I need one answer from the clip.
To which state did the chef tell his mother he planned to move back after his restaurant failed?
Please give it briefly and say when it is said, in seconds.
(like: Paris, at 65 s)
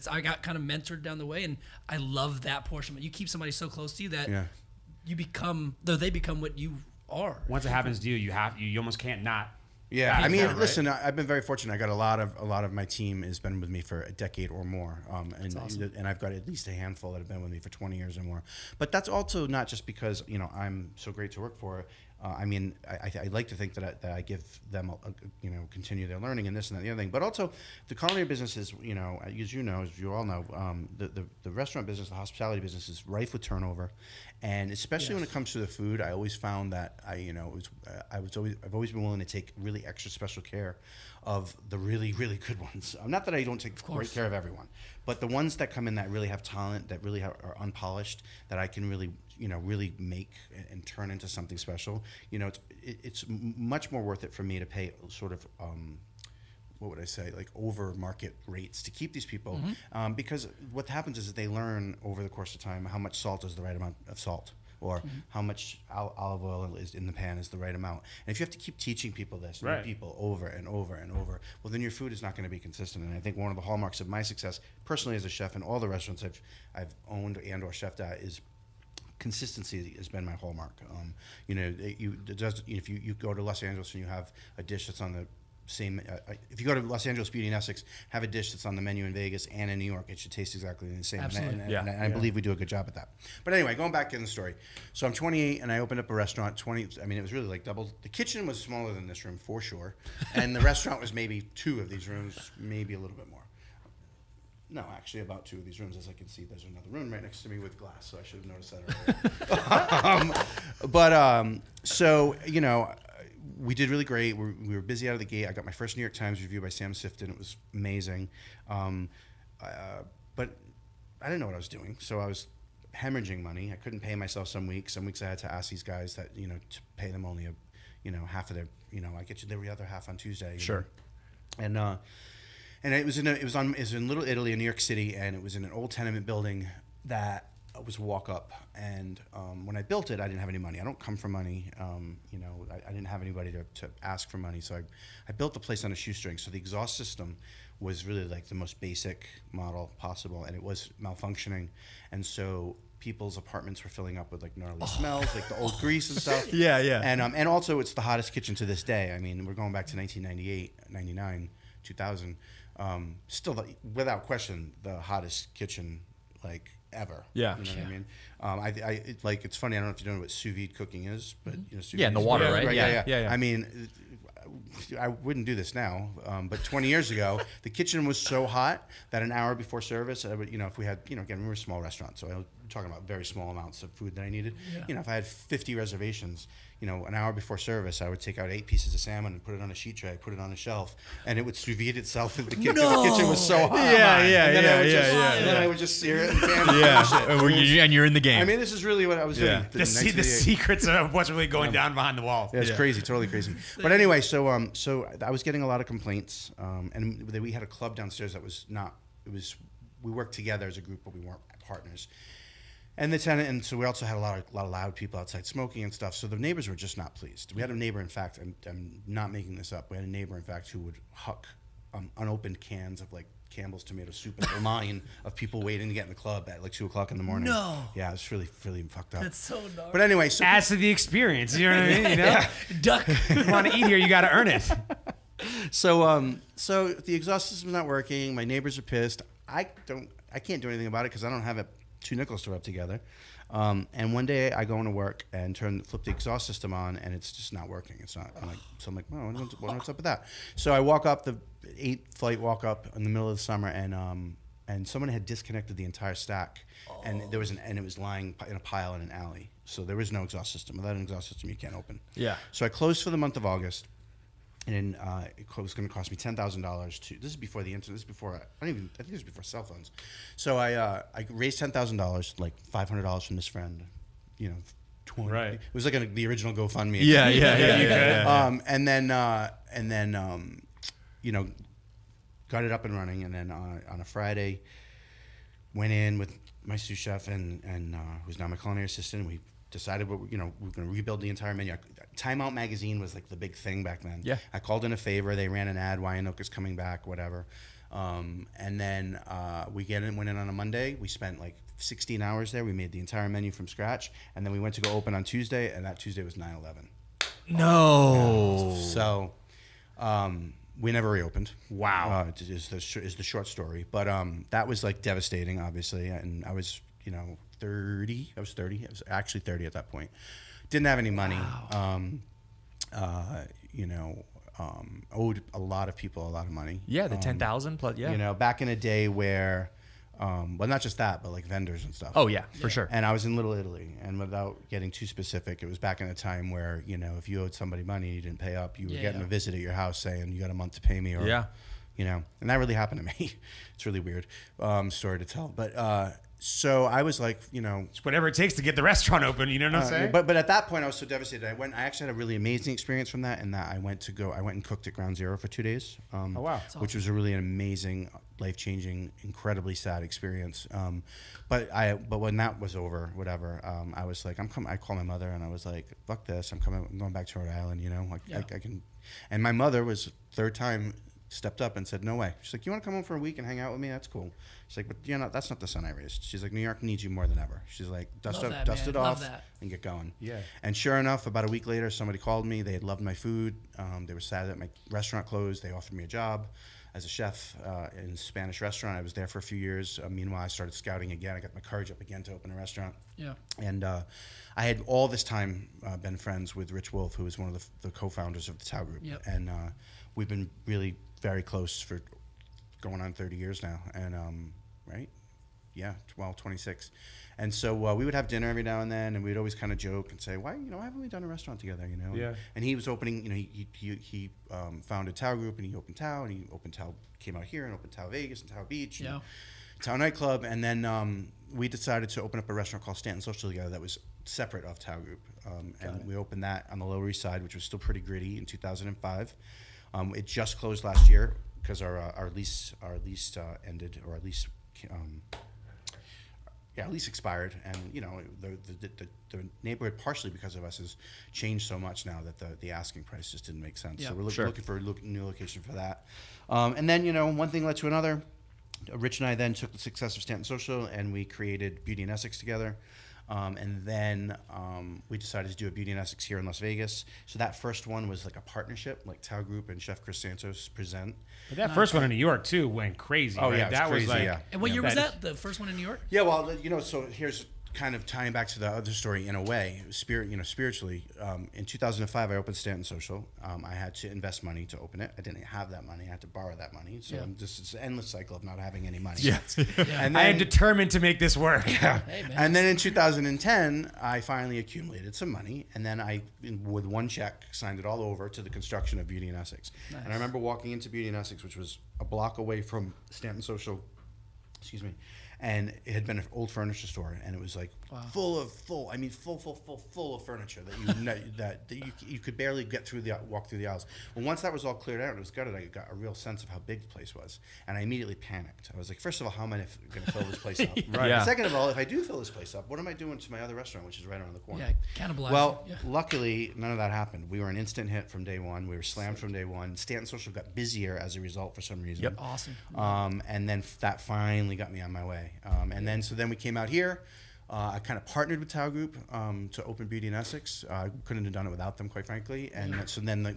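Rhode Island, at 367 s.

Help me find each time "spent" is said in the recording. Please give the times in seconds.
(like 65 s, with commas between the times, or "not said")
301 s.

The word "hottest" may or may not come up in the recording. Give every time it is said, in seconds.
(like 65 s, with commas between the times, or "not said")
158 s, 164 s.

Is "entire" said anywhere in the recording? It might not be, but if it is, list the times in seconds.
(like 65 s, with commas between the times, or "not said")
255 s, 291 s, 302 s.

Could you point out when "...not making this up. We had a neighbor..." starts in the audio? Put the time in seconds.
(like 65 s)
219 s.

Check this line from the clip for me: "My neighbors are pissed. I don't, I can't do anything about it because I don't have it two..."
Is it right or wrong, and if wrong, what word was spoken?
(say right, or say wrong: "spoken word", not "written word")
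right.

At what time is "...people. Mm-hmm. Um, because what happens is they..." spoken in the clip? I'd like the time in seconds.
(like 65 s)
59 s.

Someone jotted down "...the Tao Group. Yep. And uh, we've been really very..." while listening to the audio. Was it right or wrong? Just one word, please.
right.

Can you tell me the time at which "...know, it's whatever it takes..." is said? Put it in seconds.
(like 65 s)
347 s.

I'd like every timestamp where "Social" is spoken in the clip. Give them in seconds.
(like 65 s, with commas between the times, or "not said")
423 s, 450 s, 472 s, 493 s, 520 s.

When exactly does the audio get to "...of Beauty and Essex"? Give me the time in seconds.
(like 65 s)
488 s.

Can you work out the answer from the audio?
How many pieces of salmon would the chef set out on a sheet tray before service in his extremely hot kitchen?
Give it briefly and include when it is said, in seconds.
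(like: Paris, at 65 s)
8, at 188 s.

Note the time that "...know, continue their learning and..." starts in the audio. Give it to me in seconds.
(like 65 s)
25 s.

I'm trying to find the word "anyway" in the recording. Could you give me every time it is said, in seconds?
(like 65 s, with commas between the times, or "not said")
93 s, 203 s, 230 s.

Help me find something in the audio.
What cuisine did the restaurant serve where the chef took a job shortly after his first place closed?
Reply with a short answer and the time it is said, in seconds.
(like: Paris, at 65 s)
Spanish, at 388 s.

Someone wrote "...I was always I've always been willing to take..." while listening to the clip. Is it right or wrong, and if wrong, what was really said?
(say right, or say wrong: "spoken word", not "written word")
right.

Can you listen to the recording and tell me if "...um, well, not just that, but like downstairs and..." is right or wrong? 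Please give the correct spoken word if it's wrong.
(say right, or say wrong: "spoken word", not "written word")
wrong: "vendors", not "downstairs".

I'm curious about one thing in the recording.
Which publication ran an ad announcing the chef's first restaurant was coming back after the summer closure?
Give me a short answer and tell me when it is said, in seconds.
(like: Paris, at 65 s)
Time Out, at 292 s.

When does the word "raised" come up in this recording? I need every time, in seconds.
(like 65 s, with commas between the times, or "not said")
271 s, 375 s.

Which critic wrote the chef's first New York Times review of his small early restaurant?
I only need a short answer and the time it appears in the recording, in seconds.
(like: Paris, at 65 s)
Sam Sifton, at 116 s.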